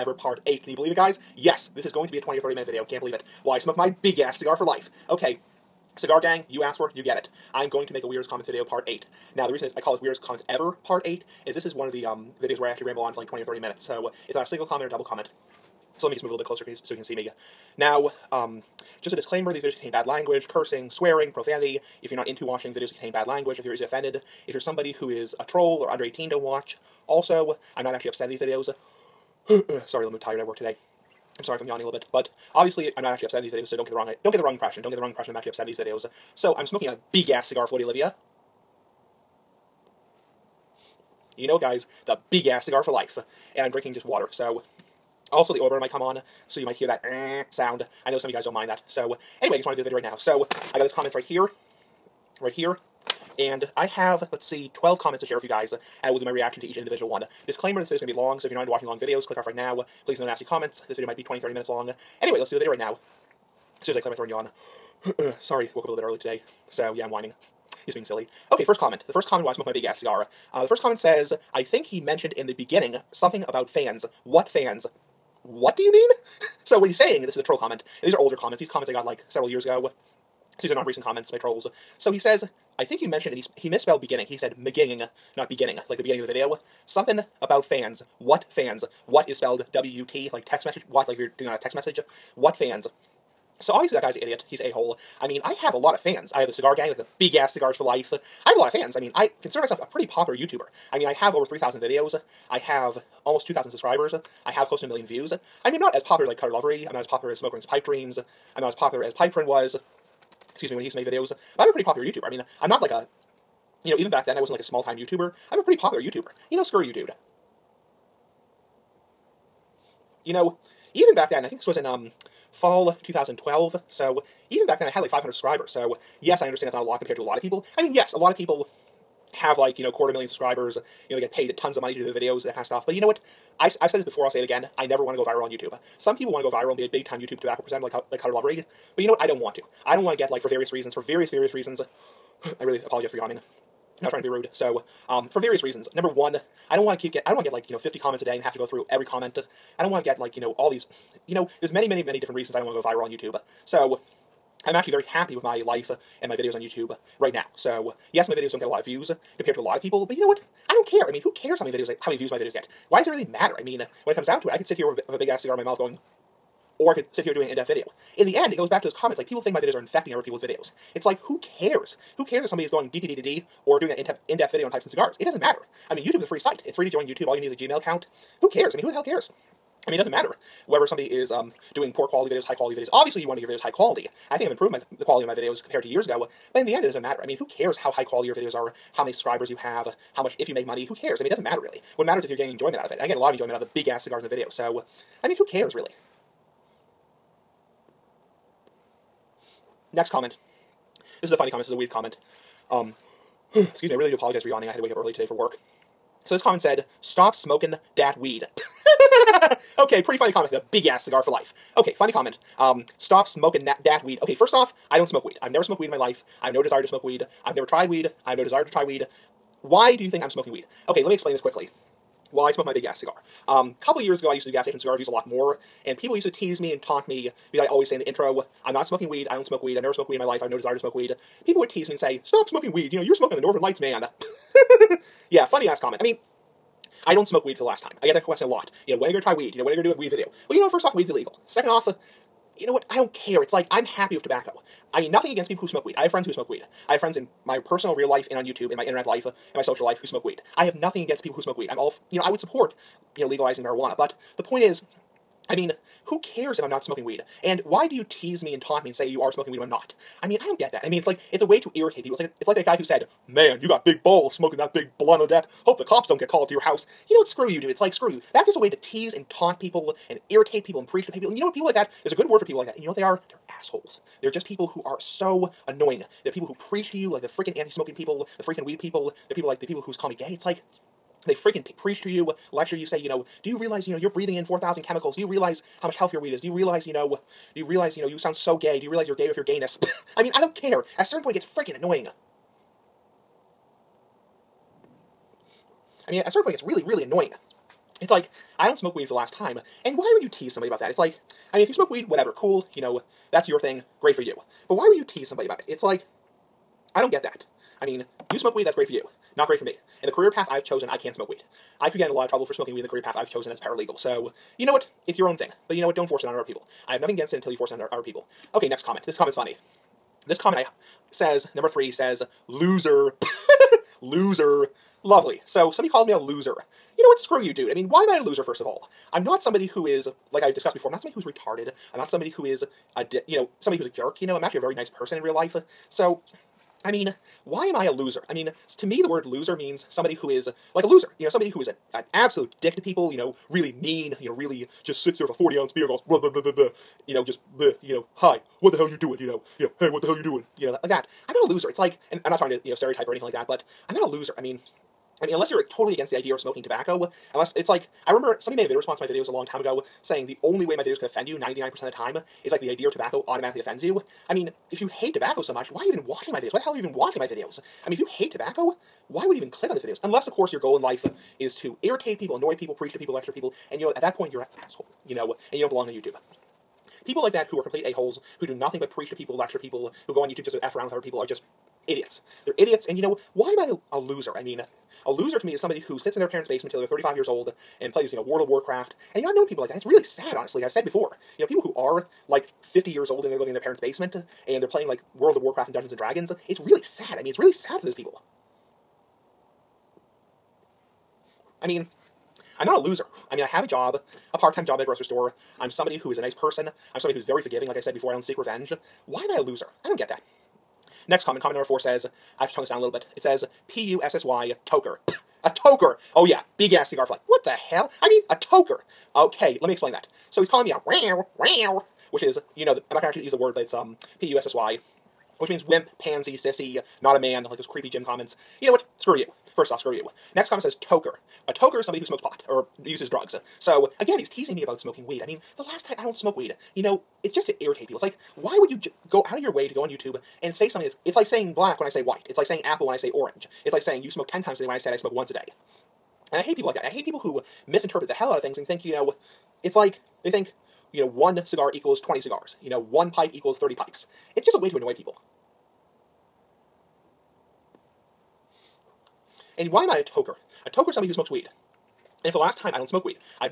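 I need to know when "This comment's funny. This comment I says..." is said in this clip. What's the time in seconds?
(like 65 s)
319 s.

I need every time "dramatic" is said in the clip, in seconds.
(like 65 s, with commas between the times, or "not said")
not said.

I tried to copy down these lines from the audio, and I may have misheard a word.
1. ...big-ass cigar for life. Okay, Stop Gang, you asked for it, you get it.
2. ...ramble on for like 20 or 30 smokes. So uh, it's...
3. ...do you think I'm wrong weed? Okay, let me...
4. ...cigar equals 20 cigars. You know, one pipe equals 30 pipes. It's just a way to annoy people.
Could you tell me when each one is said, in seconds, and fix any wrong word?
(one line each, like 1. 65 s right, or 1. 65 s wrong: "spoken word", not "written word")
1. 4 s wrong: "Cigar", not "Stop"
2. 12 s wrong: "minutes", not "smokes"
3. 219 s wrong: "smoking", not "wrong"
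4. 451 s right.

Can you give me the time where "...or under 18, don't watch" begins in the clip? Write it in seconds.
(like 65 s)
25 s.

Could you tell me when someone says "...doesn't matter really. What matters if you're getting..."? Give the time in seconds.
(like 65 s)
191 s.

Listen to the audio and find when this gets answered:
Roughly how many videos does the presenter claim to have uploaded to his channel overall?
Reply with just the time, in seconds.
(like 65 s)
101 s.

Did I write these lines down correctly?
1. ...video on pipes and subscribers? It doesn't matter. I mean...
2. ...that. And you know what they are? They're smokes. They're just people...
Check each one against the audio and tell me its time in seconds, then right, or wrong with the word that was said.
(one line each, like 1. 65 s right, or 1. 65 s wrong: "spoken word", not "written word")
1. 174 s wrong: "cigars", not "subscribers"
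2. 272 s wrong: "assholes", not "smokes".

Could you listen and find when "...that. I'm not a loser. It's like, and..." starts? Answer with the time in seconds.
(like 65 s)
350 s.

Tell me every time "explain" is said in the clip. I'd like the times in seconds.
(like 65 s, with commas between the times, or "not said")
221 s, 419 s.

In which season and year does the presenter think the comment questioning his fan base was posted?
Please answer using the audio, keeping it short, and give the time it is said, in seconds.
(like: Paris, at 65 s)
fall 2012, at 122 s.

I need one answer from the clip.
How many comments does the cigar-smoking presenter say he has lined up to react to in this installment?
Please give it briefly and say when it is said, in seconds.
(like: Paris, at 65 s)
12, at 54 s.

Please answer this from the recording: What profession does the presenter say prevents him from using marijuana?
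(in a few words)
paralegal.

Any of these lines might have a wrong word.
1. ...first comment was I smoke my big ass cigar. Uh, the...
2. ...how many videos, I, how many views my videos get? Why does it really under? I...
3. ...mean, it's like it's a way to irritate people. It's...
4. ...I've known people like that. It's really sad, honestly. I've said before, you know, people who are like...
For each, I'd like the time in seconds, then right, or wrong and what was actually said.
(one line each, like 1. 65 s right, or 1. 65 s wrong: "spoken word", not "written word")
1. 69 s right
2. 161 s wrong: "matter", not "under"
3. 260 s right
4. 389 s right.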